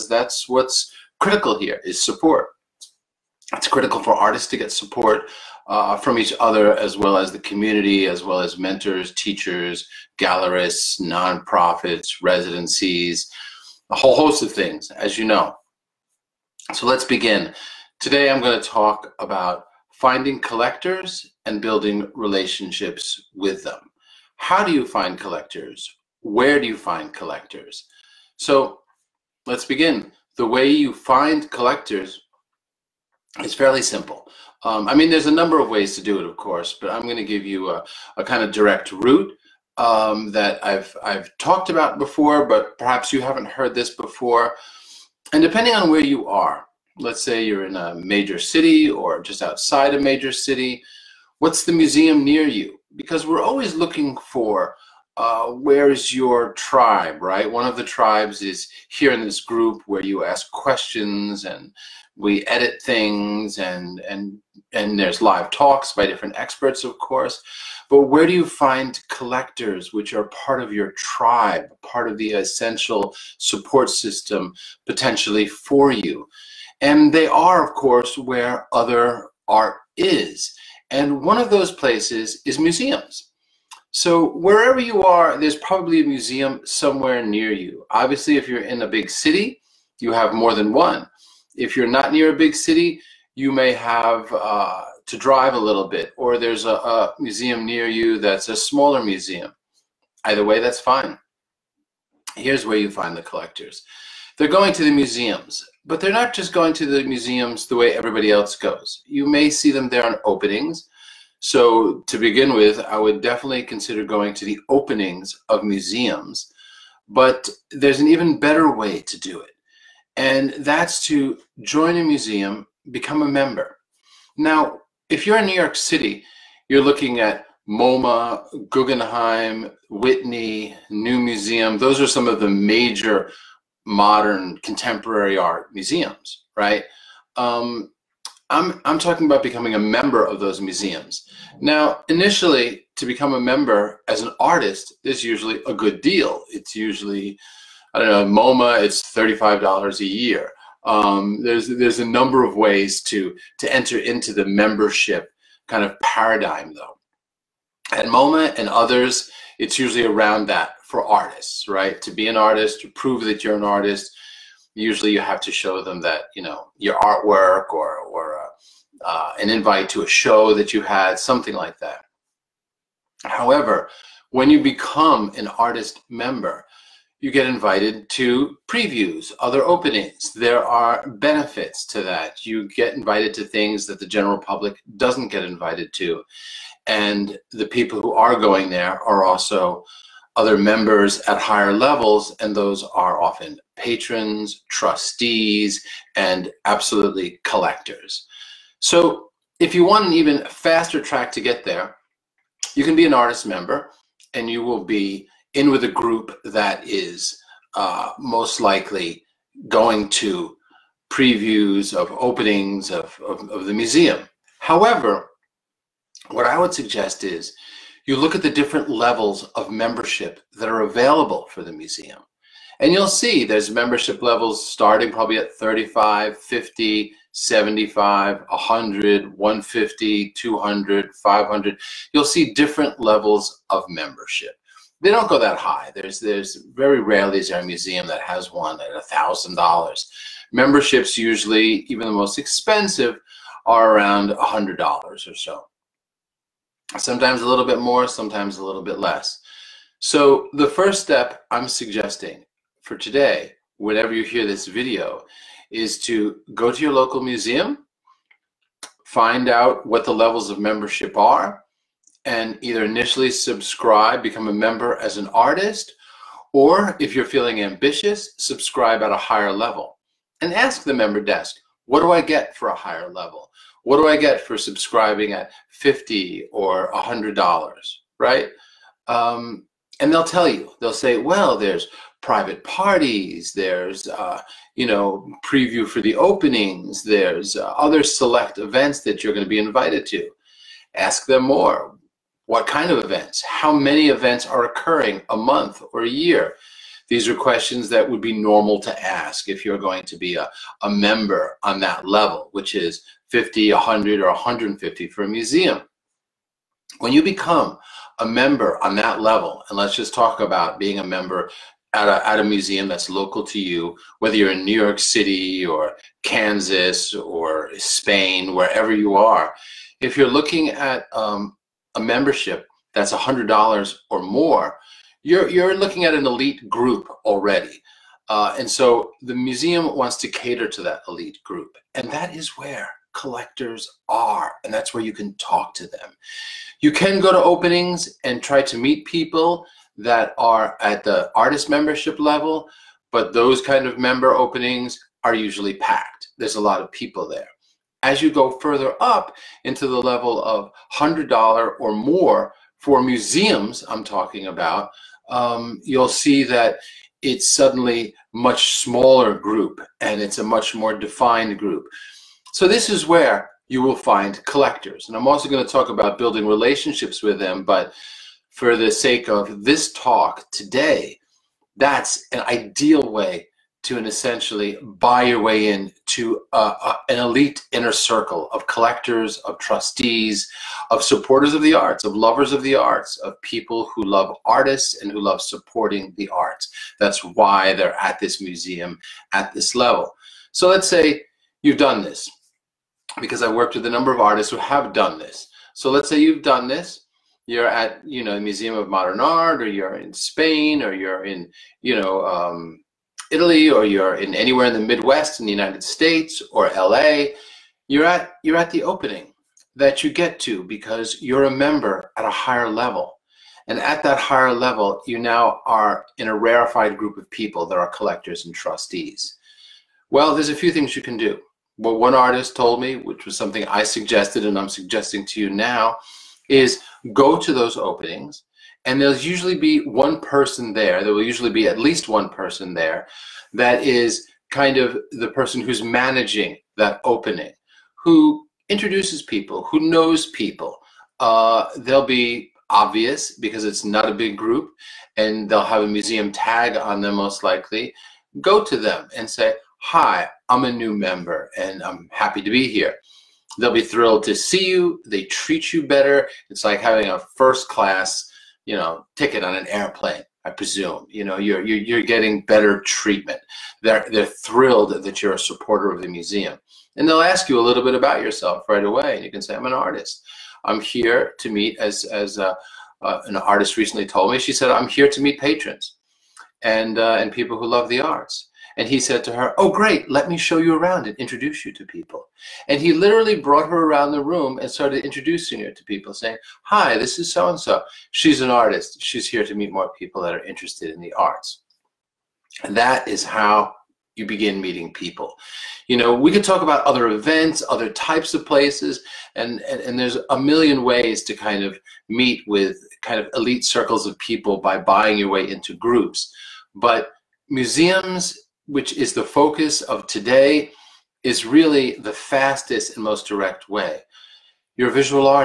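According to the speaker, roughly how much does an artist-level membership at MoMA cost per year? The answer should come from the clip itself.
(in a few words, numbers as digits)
$35.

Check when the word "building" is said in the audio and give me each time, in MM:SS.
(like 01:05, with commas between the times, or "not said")
00:21, 06:06.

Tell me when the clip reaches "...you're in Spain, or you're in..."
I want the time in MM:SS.
06:39.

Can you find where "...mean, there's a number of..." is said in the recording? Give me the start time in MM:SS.
00:34.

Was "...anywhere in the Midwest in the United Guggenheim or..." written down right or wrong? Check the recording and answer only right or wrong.
wrong.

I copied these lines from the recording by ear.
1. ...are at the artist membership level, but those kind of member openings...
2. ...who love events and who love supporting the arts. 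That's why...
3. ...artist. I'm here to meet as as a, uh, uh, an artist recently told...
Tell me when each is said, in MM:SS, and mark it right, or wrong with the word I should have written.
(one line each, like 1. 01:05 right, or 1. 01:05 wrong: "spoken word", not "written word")
1. 05:40 right
2. 06:23 wrong: "artists", not "events"
3. 07:49 right.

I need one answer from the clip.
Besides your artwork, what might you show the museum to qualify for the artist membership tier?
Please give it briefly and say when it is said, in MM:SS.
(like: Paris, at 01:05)
An invite to a show, at 02:49.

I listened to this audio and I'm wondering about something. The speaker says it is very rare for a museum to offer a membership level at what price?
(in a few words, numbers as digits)
$1,000.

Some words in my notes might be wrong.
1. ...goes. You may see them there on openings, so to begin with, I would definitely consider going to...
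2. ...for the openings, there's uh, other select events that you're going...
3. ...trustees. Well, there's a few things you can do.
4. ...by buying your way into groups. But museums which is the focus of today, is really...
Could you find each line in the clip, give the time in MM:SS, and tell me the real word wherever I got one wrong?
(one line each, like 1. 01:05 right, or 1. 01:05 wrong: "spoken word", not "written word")
1. 01:48 right
2. 04:45 right
3. 06:58 right
4. 08:24 right.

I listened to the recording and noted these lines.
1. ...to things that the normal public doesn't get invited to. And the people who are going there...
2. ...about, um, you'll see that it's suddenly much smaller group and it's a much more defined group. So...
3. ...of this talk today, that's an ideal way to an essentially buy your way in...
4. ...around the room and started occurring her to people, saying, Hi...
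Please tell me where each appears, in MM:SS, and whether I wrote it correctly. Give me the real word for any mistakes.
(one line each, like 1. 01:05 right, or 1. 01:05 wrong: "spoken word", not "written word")
1. 03:03 wrong: "general", not "normal"
2. 05:54 right
3. 06:09 right
4. 08:03 wrong: "introducing", not "occurring".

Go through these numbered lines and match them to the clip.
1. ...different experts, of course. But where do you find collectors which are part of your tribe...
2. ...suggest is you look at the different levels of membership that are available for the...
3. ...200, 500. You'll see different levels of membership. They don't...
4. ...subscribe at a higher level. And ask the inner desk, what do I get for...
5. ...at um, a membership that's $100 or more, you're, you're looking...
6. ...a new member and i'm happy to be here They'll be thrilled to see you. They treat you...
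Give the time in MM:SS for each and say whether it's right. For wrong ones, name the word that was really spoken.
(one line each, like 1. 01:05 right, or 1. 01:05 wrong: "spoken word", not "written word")
1. 01:06 right
2. 03:36 right
3. 03:50 right
4. 04:28 wrong: "member", not "inner"
5. 05:20 right
6. 07:30 right.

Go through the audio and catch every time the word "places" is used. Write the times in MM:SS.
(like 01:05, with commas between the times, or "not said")
01:21, 08:18.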